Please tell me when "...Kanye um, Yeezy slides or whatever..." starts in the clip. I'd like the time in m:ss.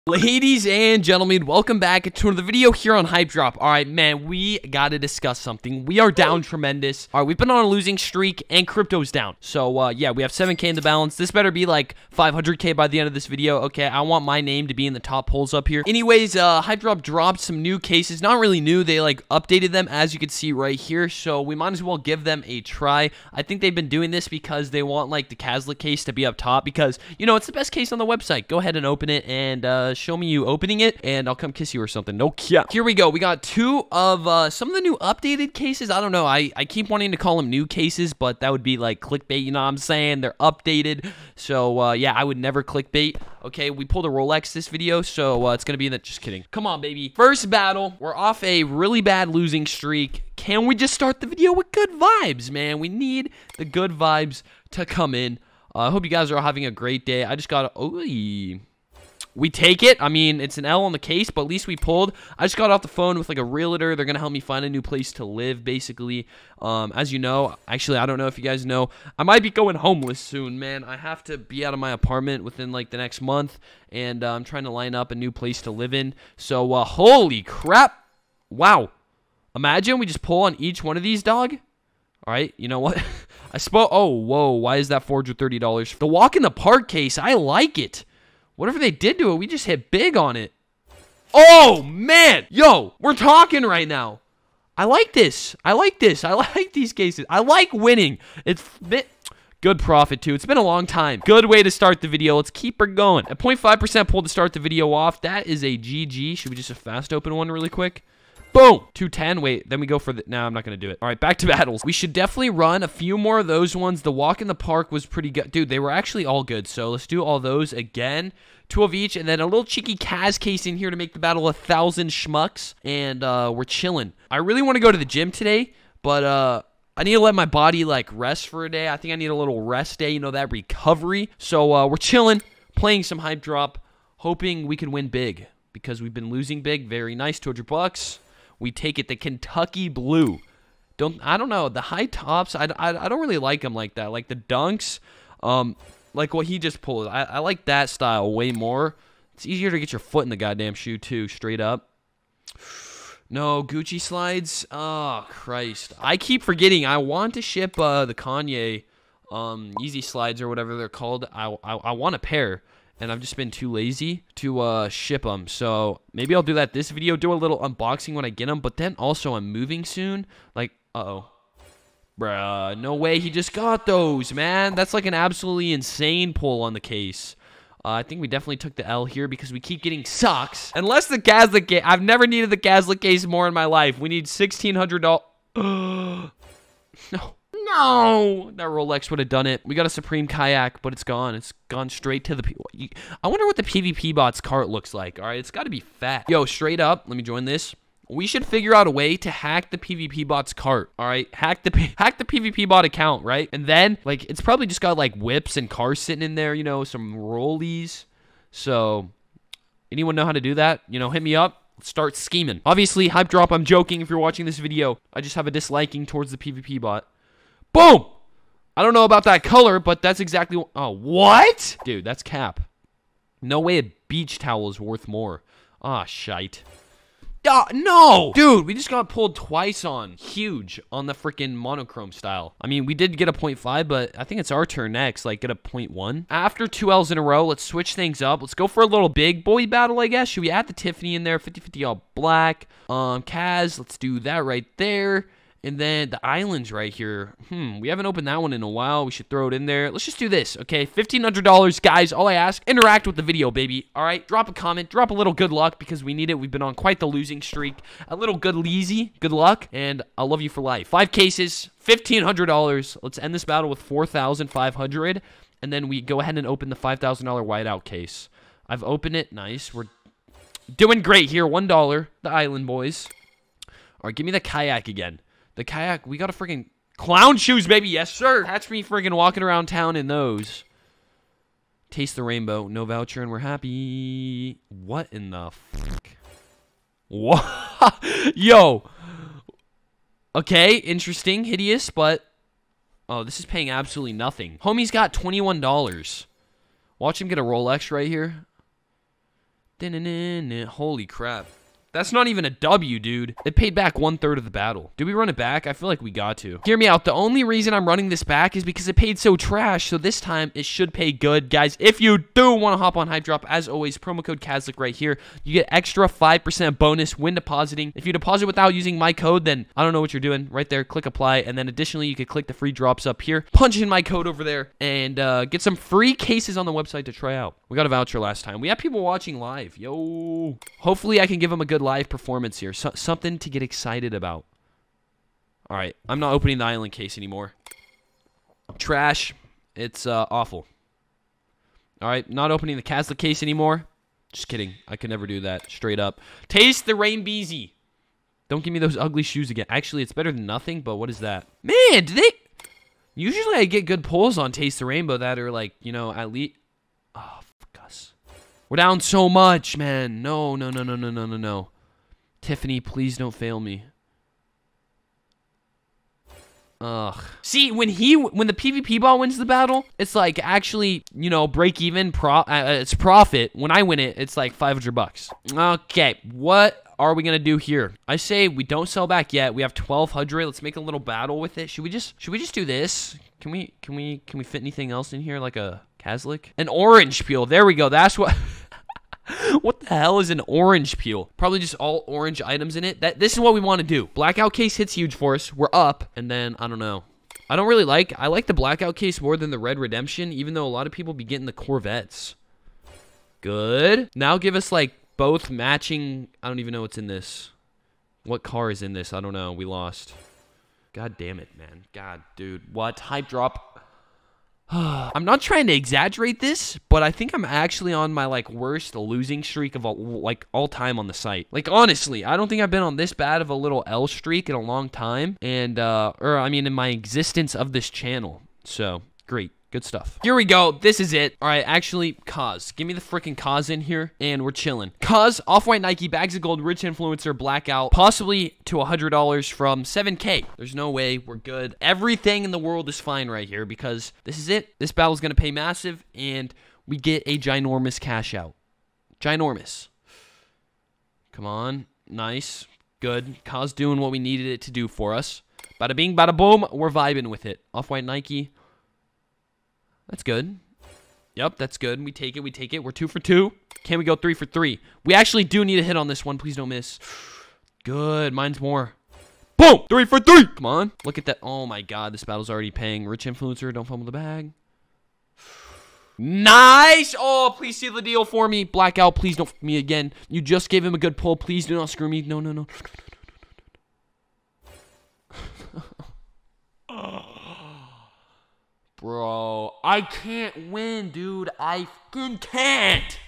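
2:38.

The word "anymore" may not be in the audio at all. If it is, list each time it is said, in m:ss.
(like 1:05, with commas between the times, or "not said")
5:37, 5:43.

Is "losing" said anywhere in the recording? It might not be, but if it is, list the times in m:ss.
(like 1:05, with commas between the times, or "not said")
0:07, 0:49, 2:16, 4:17, 6:58.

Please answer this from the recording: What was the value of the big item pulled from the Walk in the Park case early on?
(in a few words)
$430.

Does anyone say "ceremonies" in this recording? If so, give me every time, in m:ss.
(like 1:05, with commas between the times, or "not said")
not said.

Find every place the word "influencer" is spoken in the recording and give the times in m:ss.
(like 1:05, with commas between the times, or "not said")
7:16, 7:53.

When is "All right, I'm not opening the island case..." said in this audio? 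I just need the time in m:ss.
5:35.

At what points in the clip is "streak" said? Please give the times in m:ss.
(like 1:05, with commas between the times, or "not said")
0:07, 0:49, 4:17, 6:59, 7:04.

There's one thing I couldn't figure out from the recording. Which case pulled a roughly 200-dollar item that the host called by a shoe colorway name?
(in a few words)
Kentucky Blue.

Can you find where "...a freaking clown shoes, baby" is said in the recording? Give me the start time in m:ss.
4:36.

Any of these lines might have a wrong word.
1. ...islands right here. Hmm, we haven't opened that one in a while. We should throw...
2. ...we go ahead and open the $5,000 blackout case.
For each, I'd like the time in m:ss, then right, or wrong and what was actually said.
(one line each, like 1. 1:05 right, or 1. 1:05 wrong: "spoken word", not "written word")
1. 4:06 right
2. 4:25 wrong: "whiteout", not "blackout".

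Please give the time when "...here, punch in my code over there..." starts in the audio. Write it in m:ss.
5:23.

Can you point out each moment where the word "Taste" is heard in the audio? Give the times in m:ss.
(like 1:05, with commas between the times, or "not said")
4:41, 5:46, 5:54.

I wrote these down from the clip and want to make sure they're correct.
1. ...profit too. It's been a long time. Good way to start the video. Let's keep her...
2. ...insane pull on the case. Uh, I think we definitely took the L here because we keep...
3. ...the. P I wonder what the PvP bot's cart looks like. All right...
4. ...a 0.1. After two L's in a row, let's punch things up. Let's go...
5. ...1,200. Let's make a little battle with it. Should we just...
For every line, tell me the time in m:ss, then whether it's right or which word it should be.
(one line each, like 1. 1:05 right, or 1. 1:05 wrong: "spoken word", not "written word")
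1. 1:39 right
2. 2:55 right
3. 3:12 right
4. 3:55 wrong: "switch", not "punch"
5. 6:19 right.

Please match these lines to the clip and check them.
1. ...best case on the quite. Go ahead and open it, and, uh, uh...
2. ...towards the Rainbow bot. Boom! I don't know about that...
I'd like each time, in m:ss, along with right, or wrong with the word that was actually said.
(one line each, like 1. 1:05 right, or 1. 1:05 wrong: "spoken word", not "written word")
1. 0:27 wrong: "website", not "quite"
2. 3:36 wrong: "PvP", not "Rainbow".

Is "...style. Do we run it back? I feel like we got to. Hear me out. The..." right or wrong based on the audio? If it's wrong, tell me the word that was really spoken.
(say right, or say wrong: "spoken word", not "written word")
wrong: "battle", not "style".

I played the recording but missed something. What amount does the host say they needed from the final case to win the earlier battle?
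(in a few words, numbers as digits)
$1,600.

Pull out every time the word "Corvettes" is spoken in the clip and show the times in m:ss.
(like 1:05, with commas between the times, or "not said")
6:41.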